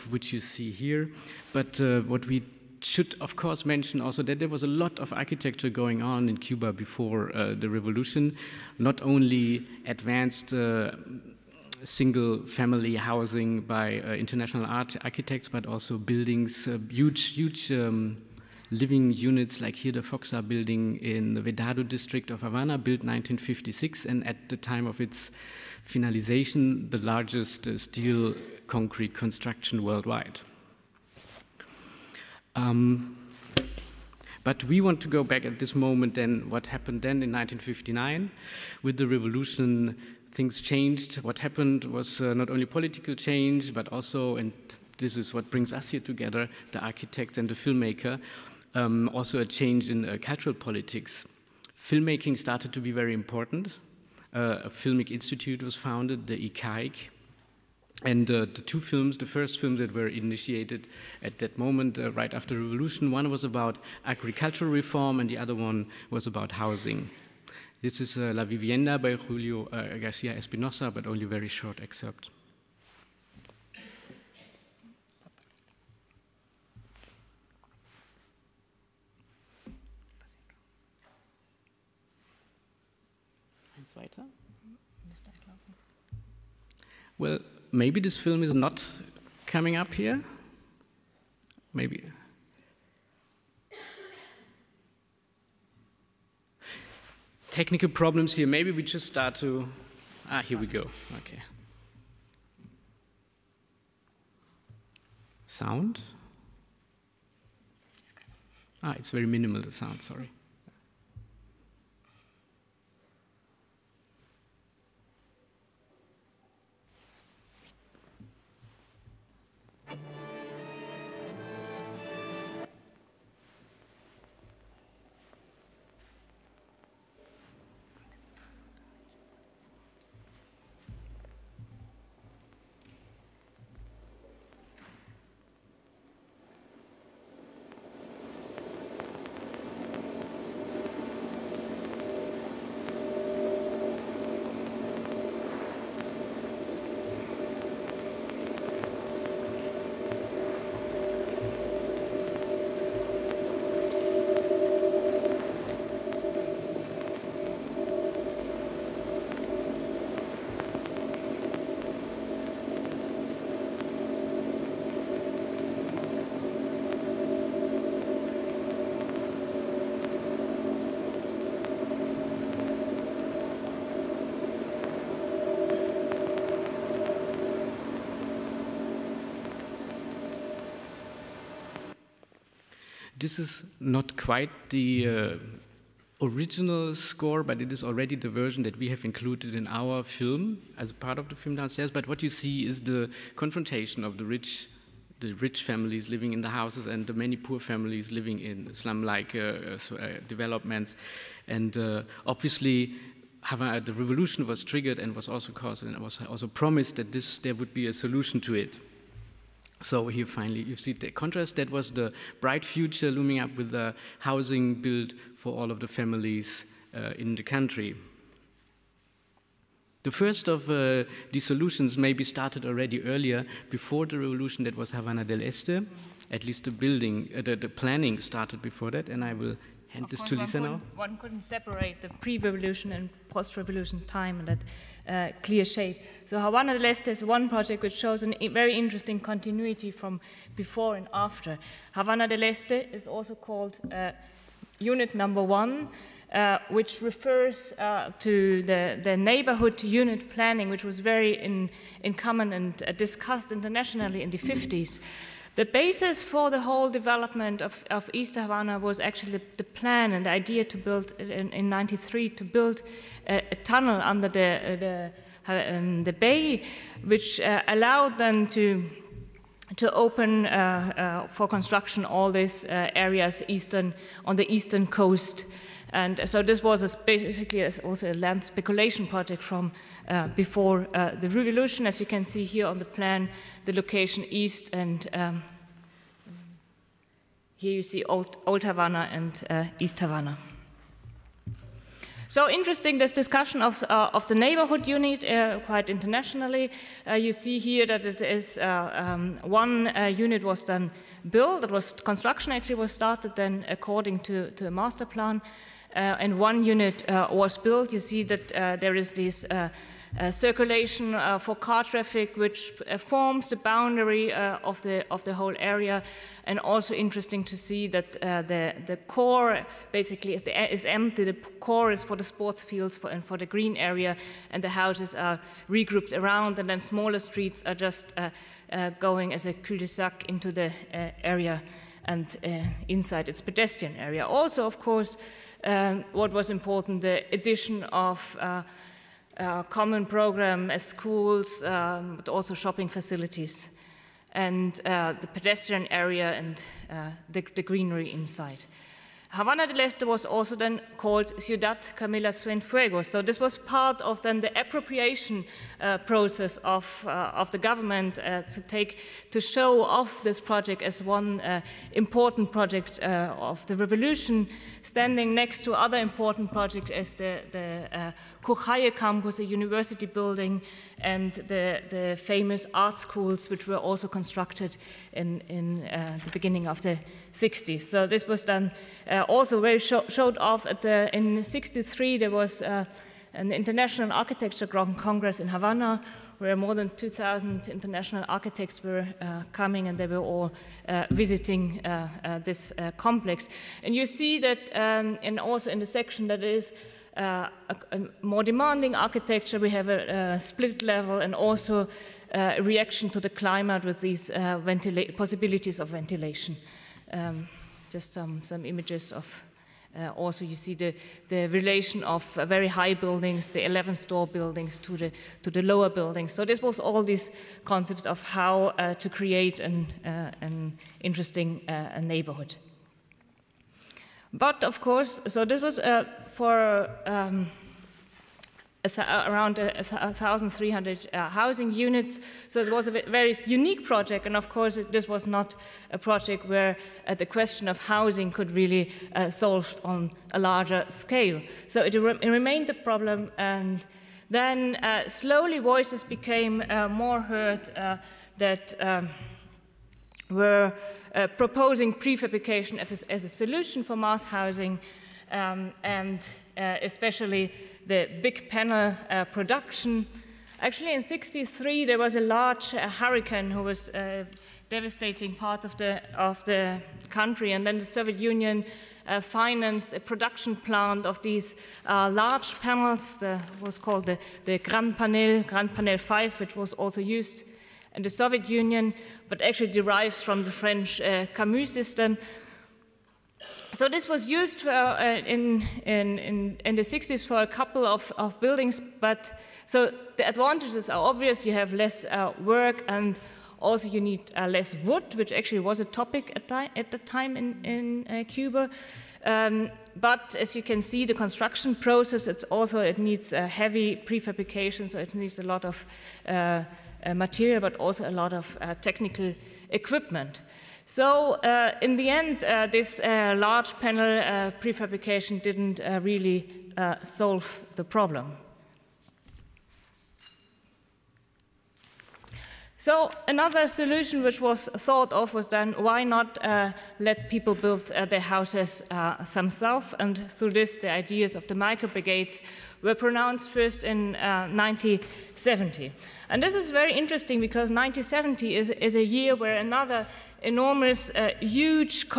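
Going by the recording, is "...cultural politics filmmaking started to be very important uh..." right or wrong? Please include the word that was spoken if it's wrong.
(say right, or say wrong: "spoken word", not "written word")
right.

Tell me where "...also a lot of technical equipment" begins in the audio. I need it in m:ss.
8:27.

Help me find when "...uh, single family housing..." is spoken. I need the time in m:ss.
0:10.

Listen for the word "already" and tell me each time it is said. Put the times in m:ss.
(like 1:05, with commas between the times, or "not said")
3:07, 3:42.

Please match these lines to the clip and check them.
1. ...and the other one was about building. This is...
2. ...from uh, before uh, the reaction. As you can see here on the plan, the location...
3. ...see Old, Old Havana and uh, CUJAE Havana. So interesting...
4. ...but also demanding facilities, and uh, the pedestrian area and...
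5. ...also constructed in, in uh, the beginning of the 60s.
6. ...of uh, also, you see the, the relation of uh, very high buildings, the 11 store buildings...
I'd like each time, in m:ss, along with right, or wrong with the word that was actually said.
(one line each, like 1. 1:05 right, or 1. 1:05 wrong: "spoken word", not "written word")
1. 1:05 wrong: "housing", not "building"
2. 4:39 wrong: "revolution", not "reaction"
3. 4:47 wrong: "East", not "CUJAE"
4. 5:42 wrong: "shopping", not "demanding"
5. 6:13 right
6. 6:49 right.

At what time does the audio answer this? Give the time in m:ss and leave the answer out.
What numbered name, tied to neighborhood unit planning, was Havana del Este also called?
4:04.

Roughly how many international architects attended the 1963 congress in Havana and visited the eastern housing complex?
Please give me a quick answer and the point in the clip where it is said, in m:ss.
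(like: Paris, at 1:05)
More than 2,000, at 6:26.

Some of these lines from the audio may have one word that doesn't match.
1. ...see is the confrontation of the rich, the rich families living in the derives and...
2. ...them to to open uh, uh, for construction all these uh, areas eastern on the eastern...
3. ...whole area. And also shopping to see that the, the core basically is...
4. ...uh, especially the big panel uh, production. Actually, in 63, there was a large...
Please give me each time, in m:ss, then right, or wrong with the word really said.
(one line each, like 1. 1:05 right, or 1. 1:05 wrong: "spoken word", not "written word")
1. 3:12 wrong: "houses", not "derives"
2. 4:28 right
3. 5:15 wrong: "interesting", not "shopping"
4. 7:36 right.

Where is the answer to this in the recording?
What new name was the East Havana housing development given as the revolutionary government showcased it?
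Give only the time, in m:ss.
5:51.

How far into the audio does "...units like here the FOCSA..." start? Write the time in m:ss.
0:19.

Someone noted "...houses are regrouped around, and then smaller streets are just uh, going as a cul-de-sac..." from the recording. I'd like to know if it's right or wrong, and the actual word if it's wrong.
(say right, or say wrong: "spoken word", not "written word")
right.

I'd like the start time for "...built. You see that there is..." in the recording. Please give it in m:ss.
5:07.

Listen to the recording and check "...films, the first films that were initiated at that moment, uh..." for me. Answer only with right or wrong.
right.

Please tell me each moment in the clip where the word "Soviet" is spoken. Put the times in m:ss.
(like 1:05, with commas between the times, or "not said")
7:47, 7:58.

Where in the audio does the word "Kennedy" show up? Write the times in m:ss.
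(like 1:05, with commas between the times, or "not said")
not said.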